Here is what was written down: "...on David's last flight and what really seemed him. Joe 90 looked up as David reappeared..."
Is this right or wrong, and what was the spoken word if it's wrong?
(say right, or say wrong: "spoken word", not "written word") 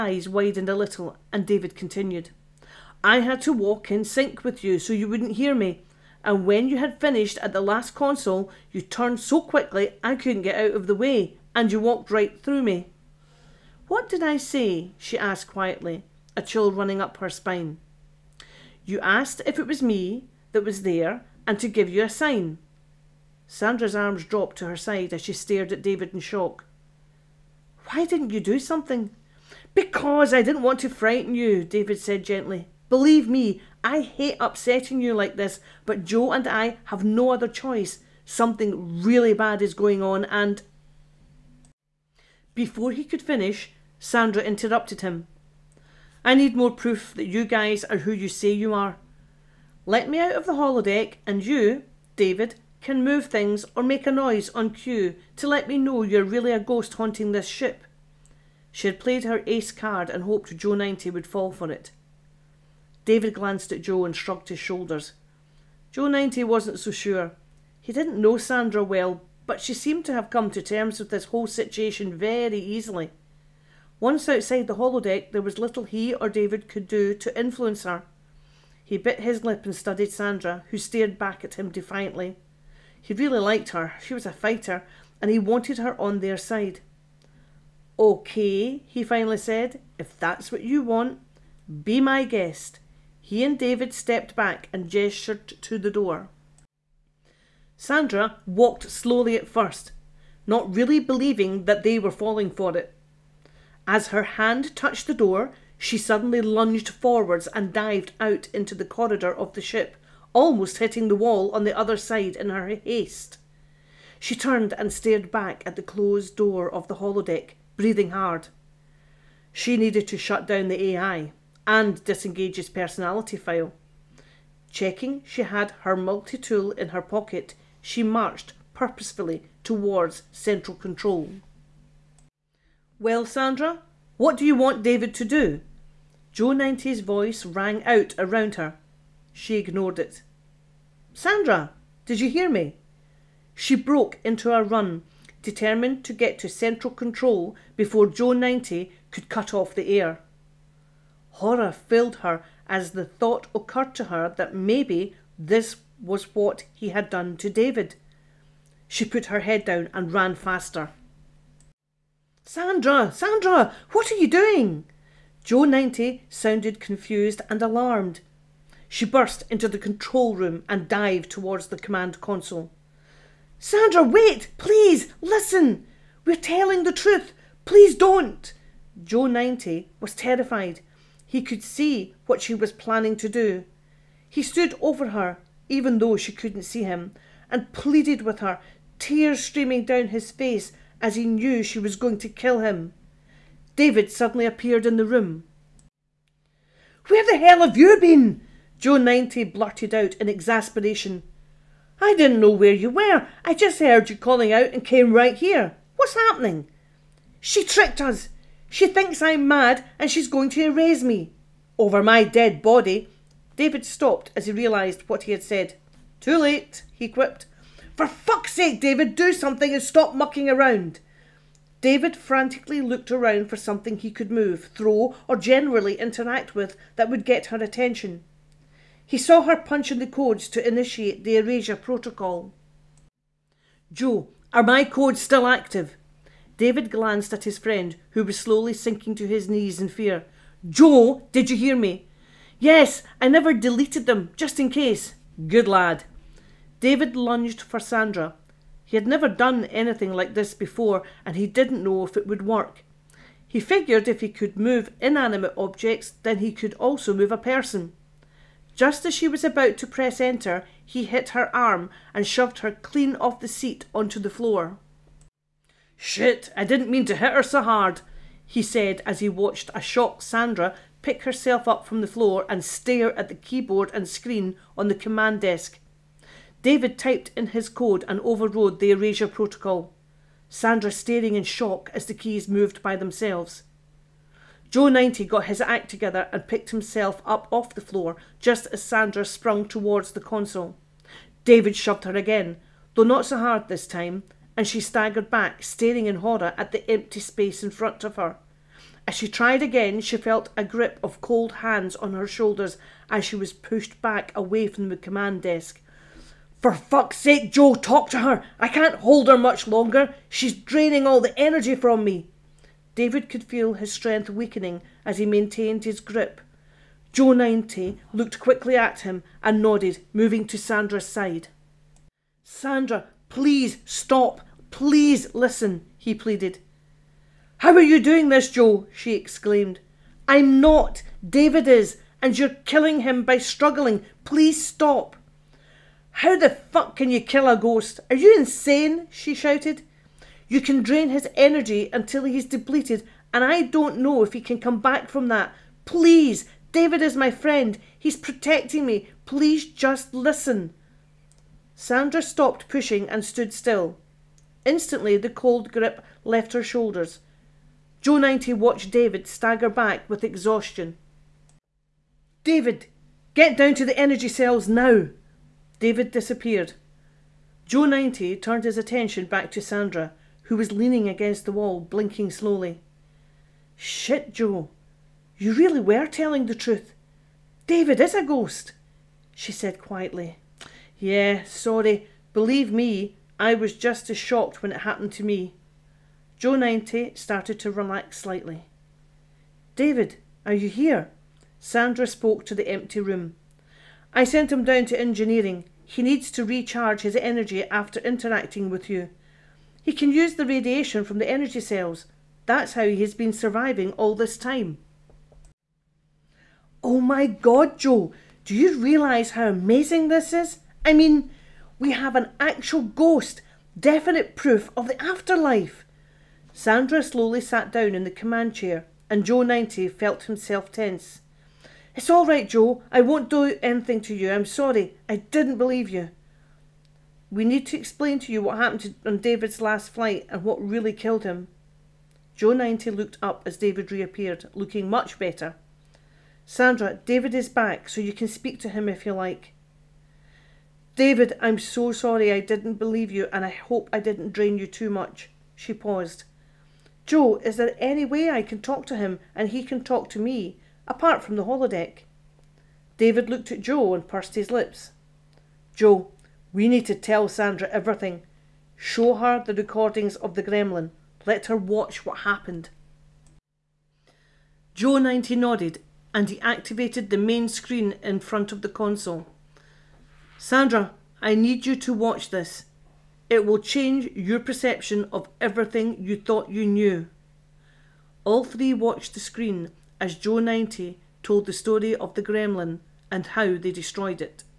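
wrong: "killed", not "seemed".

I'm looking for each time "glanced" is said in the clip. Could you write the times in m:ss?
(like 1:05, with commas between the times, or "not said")
1:03, 3:56.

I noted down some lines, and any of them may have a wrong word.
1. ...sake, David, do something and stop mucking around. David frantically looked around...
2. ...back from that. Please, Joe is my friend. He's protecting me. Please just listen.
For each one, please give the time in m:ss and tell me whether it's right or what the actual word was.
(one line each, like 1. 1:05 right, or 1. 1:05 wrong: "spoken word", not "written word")
1. 3:38 right
2. 5:44 wrong: "David", not "Joe".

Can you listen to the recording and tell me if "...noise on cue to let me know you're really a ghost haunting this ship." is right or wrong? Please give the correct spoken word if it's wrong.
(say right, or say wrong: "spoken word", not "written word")
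right.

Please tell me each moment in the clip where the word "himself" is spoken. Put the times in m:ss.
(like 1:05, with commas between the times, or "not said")
4:46, 7:00.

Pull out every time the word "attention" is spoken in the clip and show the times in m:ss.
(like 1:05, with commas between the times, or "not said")
3:47, 6:08.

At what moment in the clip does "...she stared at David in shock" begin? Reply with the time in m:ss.
0:25.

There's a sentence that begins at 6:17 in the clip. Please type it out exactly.
David is a ghost, she said quietly.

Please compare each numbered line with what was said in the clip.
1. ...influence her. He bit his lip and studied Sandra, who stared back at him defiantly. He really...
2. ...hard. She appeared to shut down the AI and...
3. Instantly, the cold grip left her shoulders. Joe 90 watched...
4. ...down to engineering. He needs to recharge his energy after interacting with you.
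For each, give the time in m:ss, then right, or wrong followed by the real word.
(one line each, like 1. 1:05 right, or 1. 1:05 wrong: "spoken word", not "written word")
1. 1:17 right
2. 1:58 wrong: "needed", not "appeared"
3. 5:54 right
4. 6:34 right.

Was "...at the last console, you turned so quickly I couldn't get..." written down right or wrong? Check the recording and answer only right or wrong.
right.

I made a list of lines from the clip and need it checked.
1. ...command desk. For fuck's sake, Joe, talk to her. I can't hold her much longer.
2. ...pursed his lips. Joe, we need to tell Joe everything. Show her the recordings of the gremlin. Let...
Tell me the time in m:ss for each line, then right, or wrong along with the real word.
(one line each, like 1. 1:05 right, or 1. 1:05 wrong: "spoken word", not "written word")
1. 5:04 right
2. 7:34 wrong: "Sandra", not "Joe".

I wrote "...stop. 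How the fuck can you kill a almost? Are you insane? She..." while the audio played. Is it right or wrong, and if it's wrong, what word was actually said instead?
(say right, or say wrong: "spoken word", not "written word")
wrong: "ghost", not "almost".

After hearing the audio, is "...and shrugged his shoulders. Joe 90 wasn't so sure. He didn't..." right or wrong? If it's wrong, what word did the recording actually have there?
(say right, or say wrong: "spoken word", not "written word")
right.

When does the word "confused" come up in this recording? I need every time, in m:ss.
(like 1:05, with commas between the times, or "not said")
2:46.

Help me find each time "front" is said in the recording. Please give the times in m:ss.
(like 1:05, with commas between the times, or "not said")
4:57, 7:48.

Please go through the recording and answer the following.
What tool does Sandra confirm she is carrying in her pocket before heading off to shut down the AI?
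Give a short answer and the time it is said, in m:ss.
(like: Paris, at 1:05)
multi-tool, at 2:05.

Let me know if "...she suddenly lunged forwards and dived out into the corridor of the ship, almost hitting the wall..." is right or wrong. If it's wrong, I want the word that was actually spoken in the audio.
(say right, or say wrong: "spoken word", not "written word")
right.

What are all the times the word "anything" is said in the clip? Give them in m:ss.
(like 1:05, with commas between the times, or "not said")
4:09, 7:03.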